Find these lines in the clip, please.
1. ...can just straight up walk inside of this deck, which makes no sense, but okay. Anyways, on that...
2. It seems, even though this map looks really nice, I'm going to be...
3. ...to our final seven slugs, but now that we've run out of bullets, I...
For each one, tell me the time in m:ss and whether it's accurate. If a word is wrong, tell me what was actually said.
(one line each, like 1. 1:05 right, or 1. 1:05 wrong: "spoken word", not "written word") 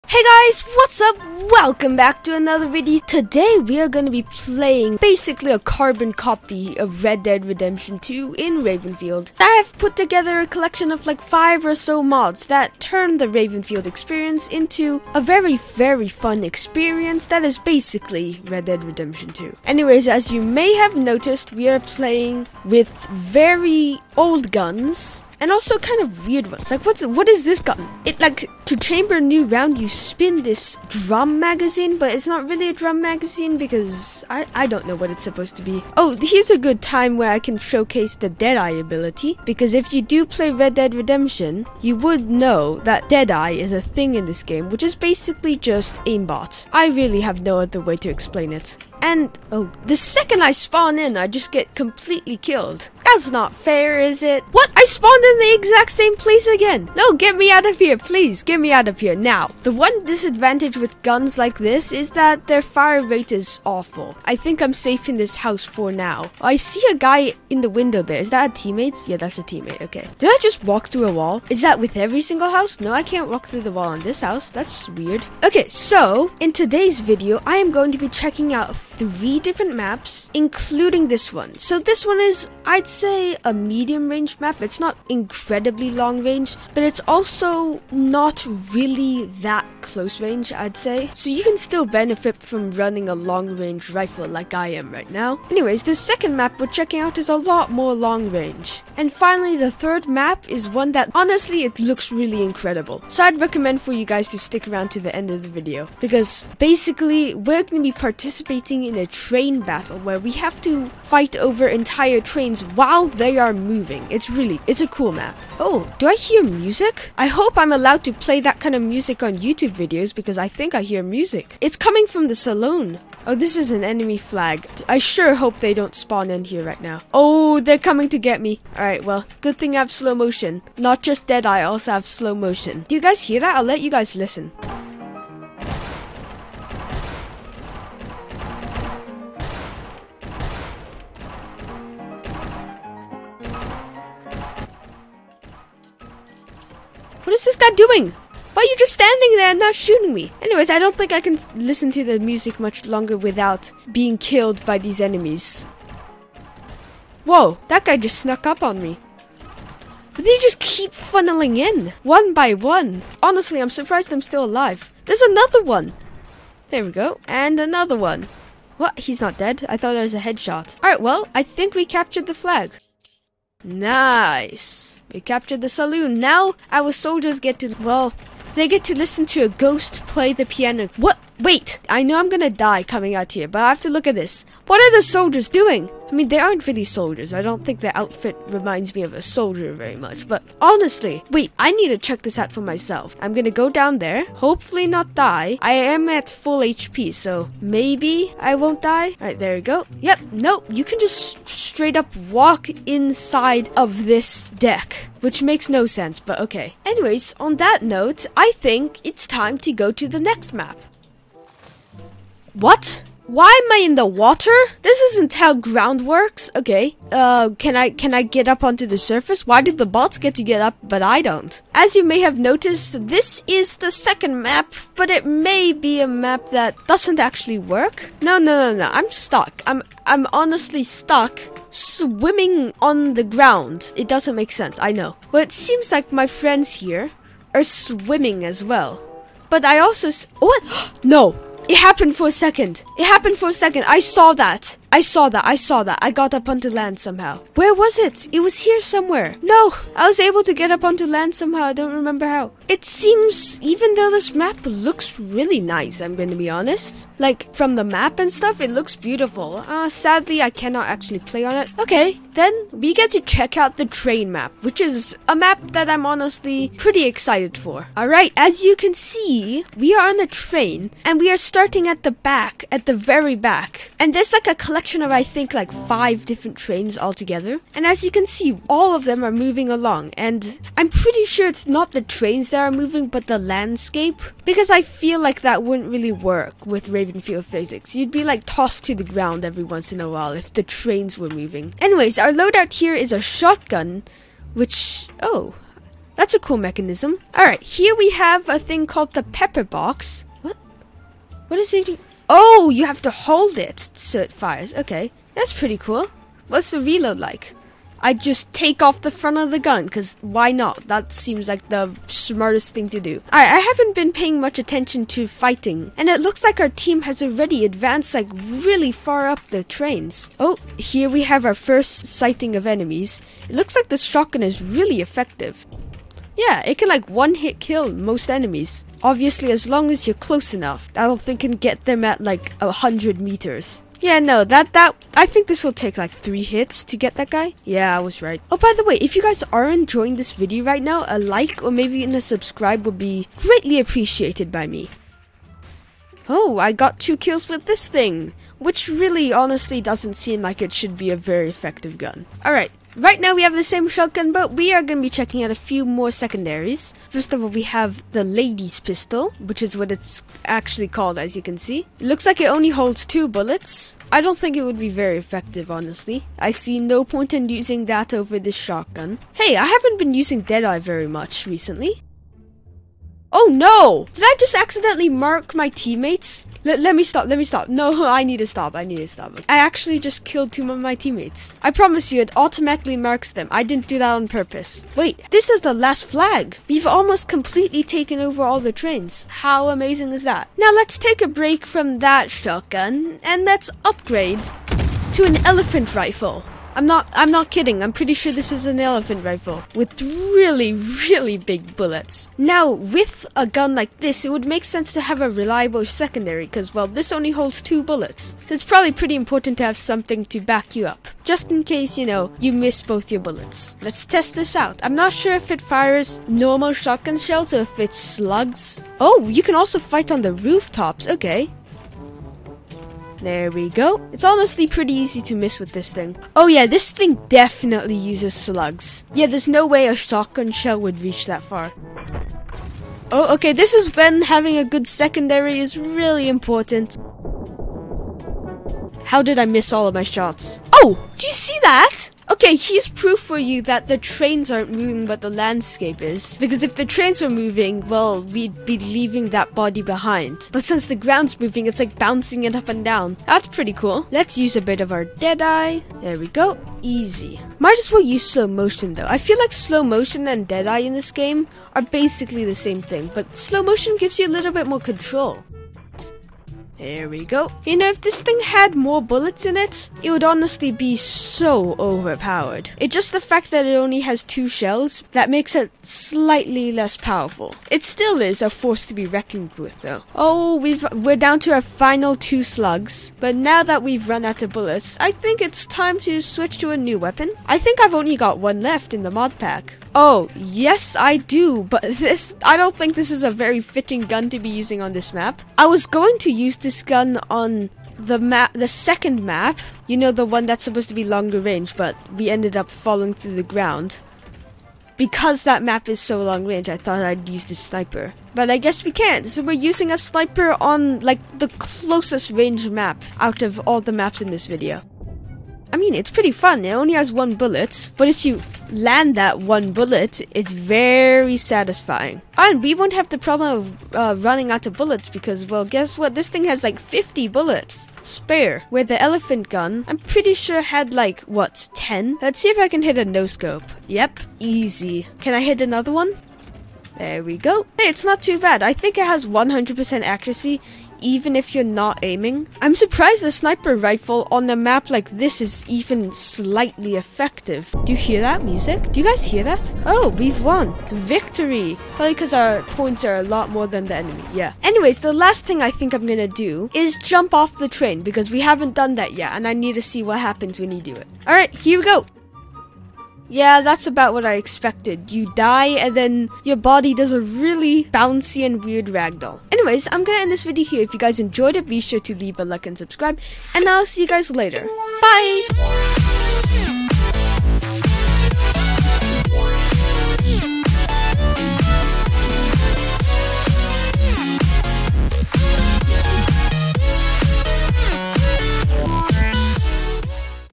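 1. 3:20 right
2. 4:12 right
3. 8:01 wrong: "two", not "seven".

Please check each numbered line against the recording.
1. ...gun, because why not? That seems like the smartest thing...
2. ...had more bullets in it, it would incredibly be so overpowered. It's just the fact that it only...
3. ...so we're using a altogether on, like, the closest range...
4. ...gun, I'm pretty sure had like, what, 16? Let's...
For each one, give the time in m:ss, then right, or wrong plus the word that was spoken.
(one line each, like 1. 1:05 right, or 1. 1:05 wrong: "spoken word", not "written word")
1. 5:09 right
2. 7:48 wrong: "honestly", not "incredibly"
3. 8:29 wrong: "sniper", not "altogether"
4. 8:49 wrong: "10", not "16".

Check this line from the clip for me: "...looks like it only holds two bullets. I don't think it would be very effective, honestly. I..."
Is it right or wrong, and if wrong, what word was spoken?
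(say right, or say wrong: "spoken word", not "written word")
right.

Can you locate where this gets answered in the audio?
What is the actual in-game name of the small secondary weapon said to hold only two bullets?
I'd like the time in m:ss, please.
5:58.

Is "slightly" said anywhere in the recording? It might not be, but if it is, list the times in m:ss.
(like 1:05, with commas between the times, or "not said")
7:55, 9:06.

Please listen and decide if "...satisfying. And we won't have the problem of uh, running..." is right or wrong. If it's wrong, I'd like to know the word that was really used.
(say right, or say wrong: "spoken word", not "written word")
right.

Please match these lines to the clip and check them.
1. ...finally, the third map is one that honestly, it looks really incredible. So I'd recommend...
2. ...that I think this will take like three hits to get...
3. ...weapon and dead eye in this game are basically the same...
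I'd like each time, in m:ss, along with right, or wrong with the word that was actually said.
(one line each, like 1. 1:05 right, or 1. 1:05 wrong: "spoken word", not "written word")
1. 1:39 right
2. 5:34 right
3. 7:39 wrong: "motion", not "weapon".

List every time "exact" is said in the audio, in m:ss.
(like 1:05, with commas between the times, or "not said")
0:55.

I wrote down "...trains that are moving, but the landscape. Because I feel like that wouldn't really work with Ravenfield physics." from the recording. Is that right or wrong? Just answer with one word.
right.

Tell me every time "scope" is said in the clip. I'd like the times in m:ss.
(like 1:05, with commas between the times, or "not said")
8:53.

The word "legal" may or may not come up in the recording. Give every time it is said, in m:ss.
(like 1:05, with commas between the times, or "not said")
not said.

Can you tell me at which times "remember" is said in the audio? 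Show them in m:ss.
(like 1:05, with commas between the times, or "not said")
4:11.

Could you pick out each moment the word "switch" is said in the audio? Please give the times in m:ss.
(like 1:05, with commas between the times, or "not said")
8:06.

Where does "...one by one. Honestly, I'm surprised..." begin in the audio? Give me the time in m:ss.
2:42.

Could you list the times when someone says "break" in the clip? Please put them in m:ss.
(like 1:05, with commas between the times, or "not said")
6:31.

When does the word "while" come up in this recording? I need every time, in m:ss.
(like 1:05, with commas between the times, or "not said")
1:52, 4:50.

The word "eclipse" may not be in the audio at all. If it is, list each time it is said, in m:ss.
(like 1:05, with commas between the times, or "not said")
not said.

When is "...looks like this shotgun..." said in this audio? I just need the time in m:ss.
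5:23.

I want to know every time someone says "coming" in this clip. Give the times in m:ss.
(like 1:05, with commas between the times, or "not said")
2:01, 2:07, 3:02.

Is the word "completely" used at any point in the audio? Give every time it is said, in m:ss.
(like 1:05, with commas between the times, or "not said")
0:51, 6:27.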